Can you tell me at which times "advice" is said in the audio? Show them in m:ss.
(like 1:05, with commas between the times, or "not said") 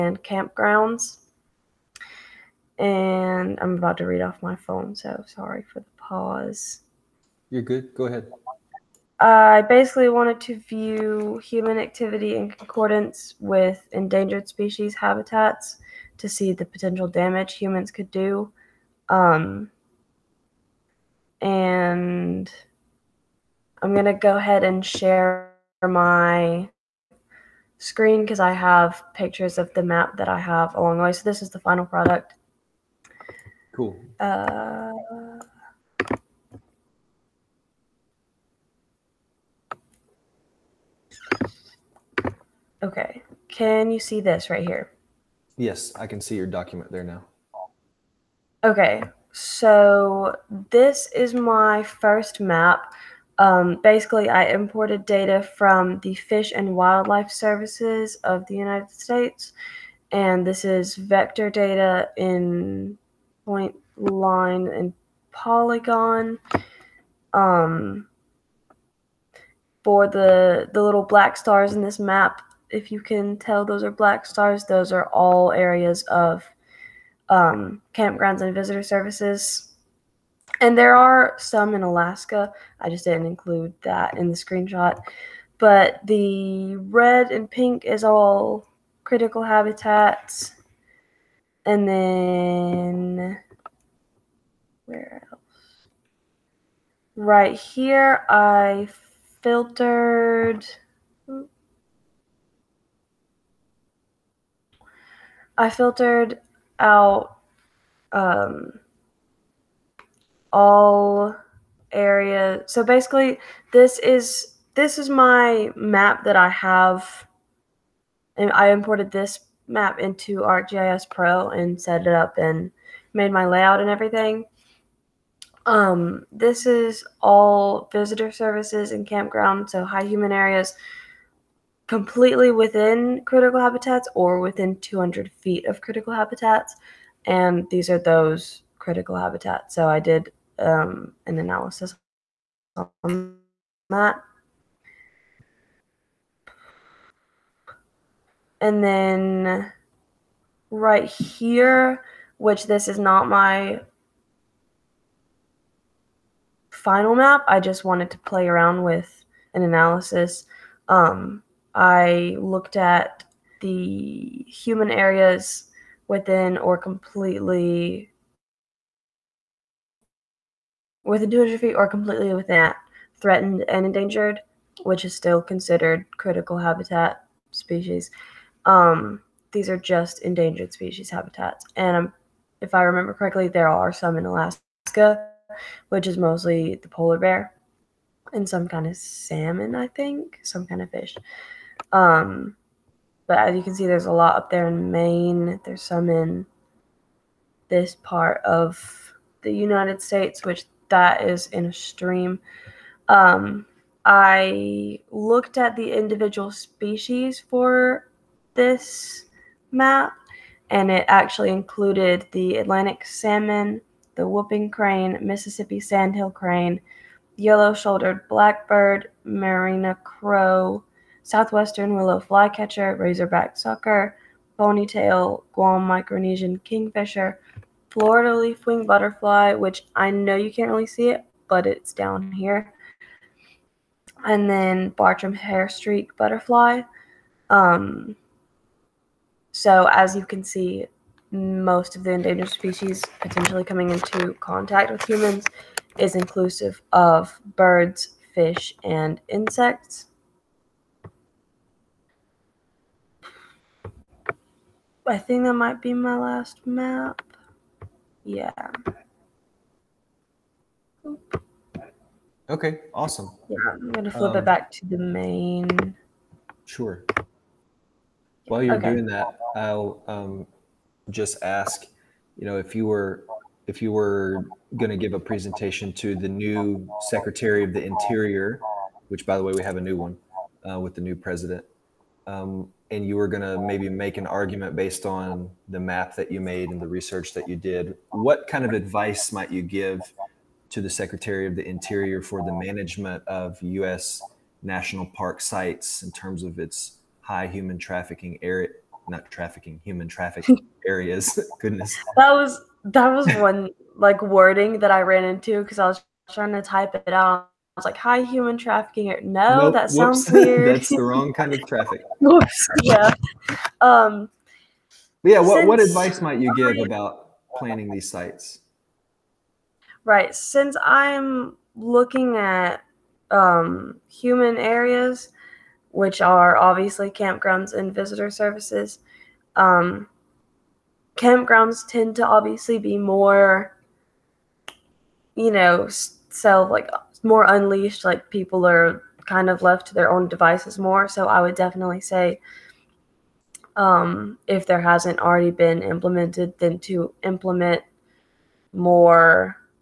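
4:48, 5:15.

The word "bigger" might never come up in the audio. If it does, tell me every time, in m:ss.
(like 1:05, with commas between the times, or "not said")
not said.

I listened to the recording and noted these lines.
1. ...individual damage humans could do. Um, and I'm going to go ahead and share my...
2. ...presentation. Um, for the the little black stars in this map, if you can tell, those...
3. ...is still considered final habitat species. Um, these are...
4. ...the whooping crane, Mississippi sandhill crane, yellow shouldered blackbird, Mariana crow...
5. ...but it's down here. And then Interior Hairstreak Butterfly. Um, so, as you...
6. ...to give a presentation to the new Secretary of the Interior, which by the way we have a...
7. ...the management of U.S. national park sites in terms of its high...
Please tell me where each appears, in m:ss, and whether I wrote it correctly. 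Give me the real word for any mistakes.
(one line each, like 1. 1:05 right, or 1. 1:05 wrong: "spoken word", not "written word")
1. 0:16 wrong: "potential", not "individual"
2. 1:05 wrong: "polygon", not "presentation"
3. 2:55 wrong: "critical", not "final"
4. 3:34 right
5. 3:51 wrong: "Bartram", not "Interior"
6. 4:34 right
7. 4:52 right.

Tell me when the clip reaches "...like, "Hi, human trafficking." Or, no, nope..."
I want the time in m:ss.
5:07.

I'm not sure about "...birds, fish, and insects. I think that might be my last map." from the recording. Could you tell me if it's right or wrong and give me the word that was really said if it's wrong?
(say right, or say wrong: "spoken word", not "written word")
right.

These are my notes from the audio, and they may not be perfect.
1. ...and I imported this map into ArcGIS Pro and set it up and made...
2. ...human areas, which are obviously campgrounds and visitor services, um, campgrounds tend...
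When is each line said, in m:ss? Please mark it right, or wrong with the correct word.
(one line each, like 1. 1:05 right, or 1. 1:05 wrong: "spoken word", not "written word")
1. 1:58 right
2. 5:24 right.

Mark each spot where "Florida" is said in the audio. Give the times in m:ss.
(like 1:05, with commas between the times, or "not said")
3:47.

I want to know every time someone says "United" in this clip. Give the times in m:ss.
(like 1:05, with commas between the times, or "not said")
0:58, 3:19.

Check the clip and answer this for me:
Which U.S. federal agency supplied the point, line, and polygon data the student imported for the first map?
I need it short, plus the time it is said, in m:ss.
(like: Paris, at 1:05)
Fish and Wildlife Services, at 0:56.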